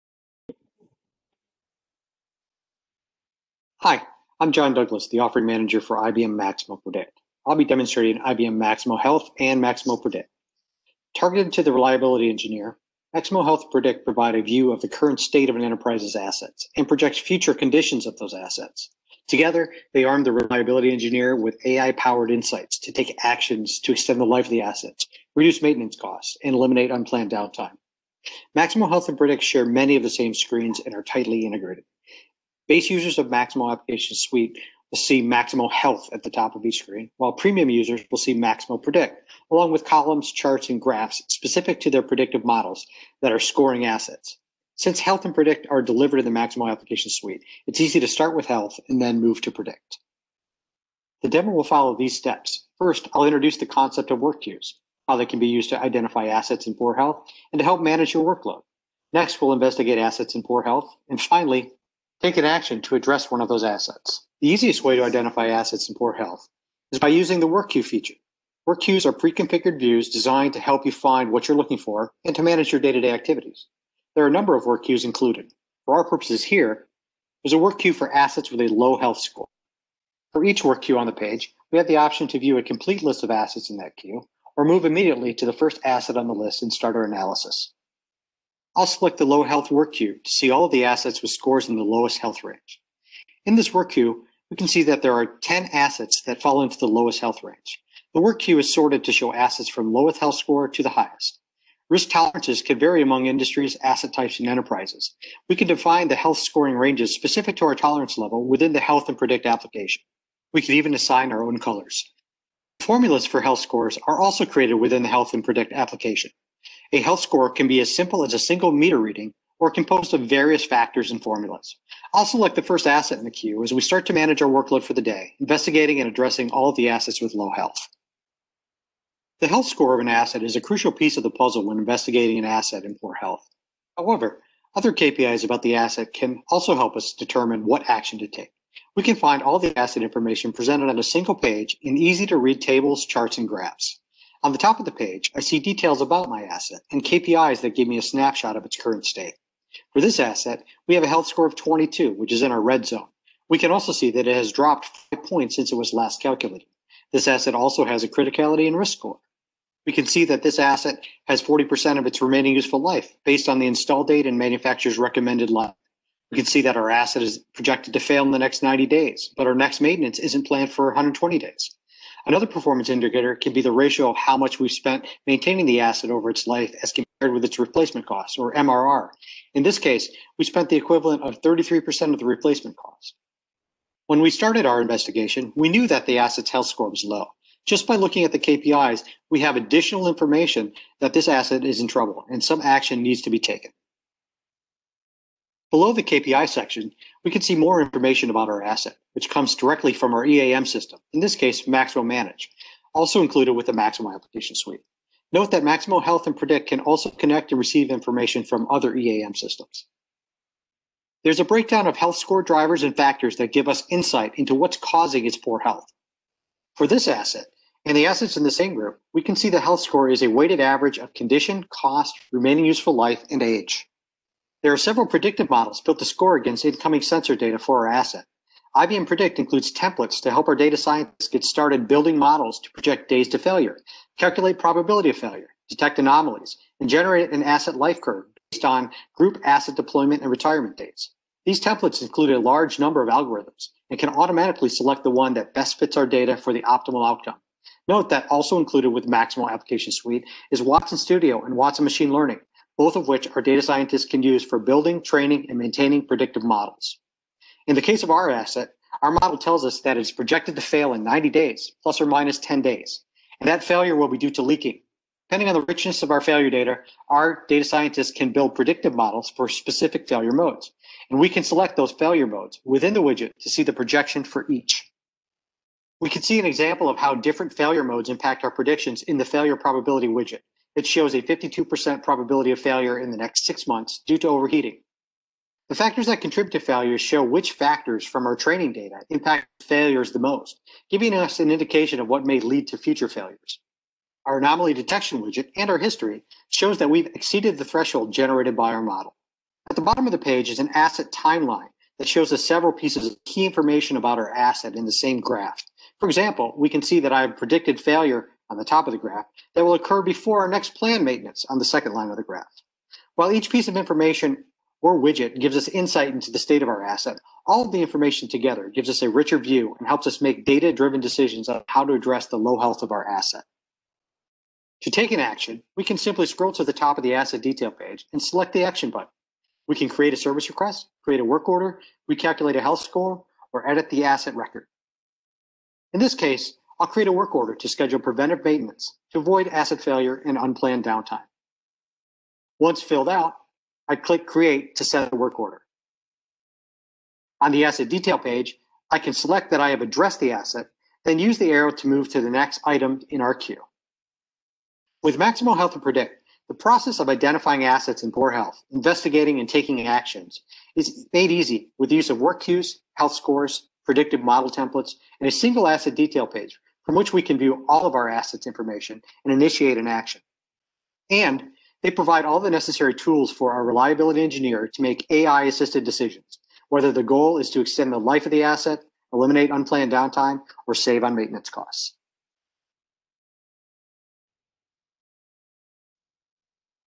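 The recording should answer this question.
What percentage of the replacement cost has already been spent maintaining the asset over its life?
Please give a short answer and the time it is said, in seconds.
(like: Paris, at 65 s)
33%, at 181 s.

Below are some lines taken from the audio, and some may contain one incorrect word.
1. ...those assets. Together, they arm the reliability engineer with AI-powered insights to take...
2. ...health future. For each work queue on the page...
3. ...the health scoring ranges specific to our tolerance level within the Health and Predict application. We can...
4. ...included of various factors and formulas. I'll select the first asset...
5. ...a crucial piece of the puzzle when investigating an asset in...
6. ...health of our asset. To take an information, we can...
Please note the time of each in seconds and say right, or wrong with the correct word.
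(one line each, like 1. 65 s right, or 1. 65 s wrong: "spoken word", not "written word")
1. 18 s right
2. 78 s wrong: "score", not "future"
3. 106 s right
4. 119 s wrong: "composed", not "included"
5. 130 s right
6. 322 s wrong: "action", not "information".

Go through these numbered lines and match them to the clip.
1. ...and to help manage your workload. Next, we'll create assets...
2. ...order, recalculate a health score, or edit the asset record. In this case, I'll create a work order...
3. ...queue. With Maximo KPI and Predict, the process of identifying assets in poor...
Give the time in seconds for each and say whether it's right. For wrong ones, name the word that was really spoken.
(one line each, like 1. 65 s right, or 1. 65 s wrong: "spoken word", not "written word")
1. 57 s wrong: "investigate", not "create"
2. 331 s right
3. 353 s wrong: "Health", not "KPI".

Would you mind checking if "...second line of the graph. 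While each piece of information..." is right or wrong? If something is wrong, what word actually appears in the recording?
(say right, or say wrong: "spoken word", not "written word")
right.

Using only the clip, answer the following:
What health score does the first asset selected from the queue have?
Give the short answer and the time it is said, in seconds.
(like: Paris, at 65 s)
22, at 151 s.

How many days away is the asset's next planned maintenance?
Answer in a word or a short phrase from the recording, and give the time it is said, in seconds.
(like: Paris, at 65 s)
120 days, at 170 s.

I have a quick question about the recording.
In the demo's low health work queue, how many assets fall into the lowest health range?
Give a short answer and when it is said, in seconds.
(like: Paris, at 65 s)
10, at 95 s.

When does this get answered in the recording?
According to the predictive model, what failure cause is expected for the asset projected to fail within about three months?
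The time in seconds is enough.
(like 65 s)
264 s.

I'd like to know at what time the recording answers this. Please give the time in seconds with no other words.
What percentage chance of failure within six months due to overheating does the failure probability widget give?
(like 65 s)
281 s.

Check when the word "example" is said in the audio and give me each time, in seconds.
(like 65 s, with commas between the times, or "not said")
276 s, 306 s.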